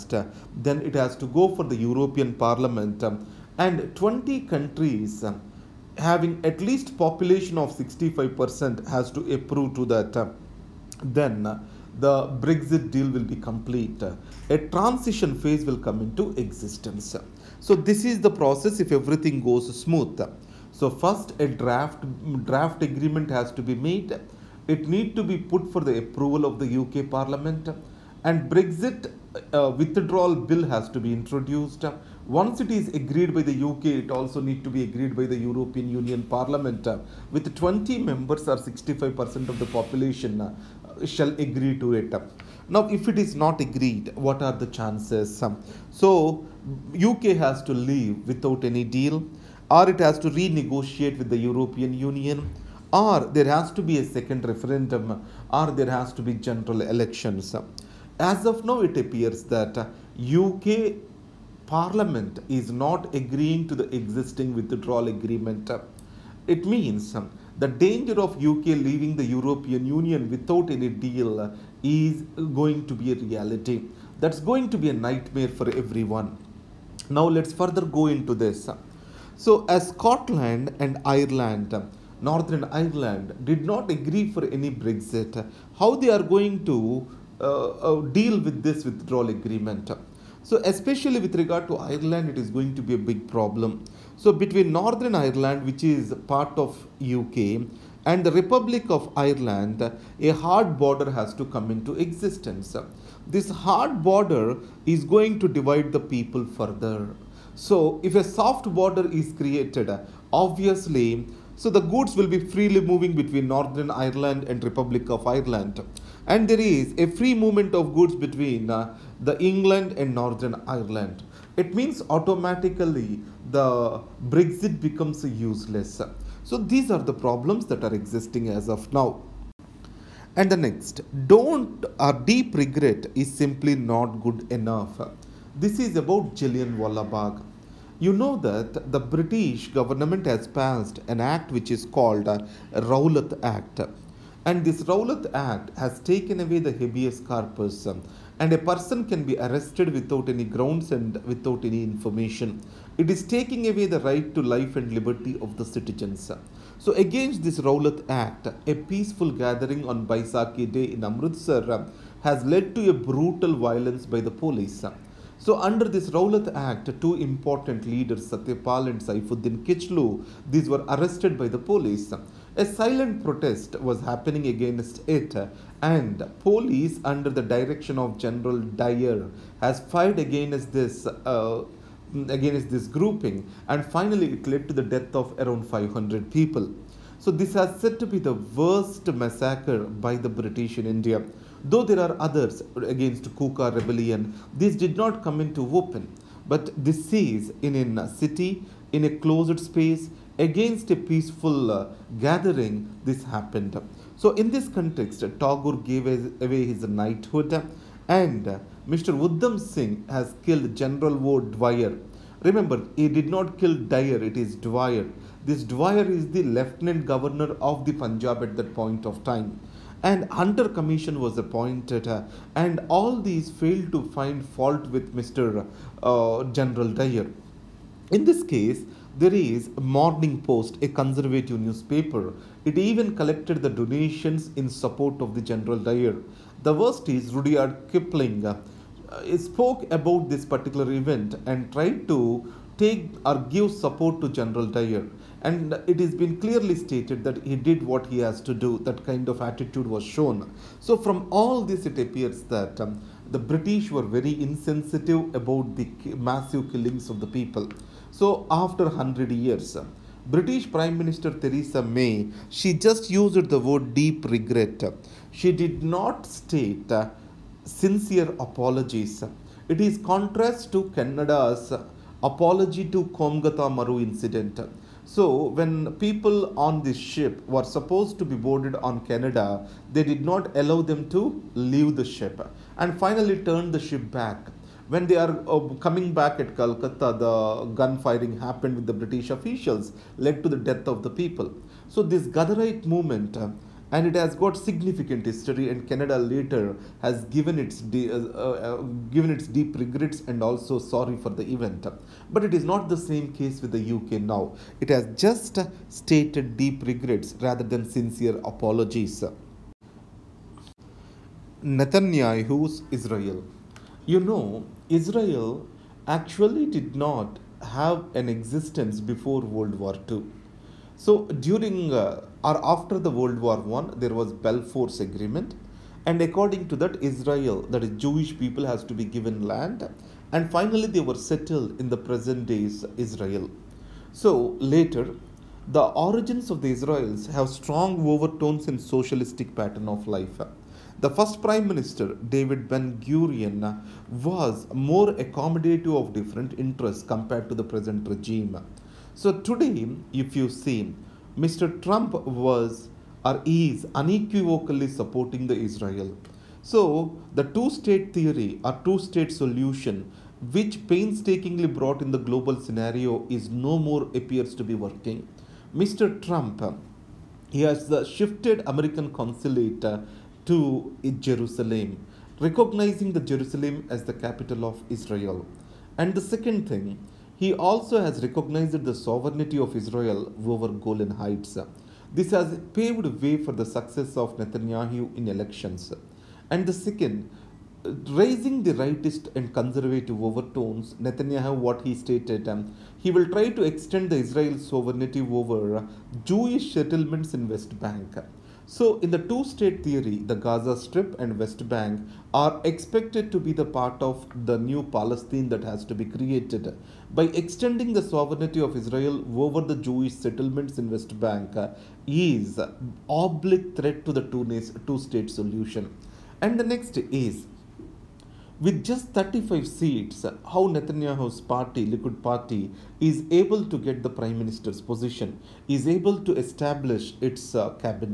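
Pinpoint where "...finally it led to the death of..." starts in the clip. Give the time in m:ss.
3:03.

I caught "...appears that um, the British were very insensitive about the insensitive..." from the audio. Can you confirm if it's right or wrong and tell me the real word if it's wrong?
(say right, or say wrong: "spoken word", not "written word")
wrong: "massive", not "insensitive".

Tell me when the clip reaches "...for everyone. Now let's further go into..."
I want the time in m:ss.
1:15.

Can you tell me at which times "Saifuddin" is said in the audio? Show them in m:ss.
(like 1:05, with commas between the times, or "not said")
2:49.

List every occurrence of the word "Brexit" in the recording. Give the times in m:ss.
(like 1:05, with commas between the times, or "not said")
0:12, 0:28, 1:24, 2:04.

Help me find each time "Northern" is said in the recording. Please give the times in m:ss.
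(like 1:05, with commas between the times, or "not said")
1:22, 1:34, 1:53, 2:00.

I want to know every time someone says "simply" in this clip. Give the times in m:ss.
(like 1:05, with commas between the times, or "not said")
2:13.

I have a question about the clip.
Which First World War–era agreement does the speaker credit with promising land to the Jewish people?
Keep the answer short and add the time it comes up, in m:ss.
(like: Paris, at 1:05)
Balfour Agreement, at 5:24.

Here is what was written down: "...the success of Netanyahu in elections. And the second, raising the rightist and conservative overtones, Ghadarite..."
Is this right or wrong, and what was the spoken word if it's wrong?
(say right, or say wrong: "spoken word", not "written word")
wrong: "Netanyahu", not "Ghadarite".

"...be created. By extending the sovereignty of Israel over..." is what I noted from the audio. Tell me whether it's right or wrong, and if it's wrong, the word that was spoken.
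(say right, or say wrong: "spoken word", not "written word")
right.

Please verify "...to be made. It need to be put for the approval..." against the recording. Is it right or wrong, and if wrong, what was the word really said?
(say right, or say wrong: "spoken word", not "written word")
right.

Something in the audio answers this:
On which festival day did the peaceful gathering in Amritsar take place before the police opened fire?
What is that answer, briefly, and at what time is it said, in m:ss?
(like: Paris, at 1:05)
Baisakhi Day, at 2:40.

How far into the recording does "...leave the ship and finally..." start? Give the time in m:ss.
4:41.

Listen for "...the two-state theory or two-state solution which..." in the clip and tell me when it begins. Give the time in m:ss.
5:57.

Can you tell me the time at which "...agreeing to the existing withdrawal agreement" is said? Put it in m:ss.
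1:03.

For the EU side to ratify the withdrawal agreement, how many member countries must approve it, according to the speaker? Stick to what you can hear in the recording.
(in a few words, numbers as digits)
20.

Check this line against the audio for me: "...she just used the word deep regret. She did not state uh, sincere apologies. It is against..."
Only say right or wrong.
wrong.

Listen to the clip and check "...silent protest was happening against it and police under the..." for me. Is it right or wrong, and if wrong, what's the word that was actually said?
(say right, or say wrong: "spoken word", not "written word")
right.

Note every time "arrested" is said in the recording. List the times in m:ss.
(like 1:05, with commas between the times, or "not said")
2:29, 2:50.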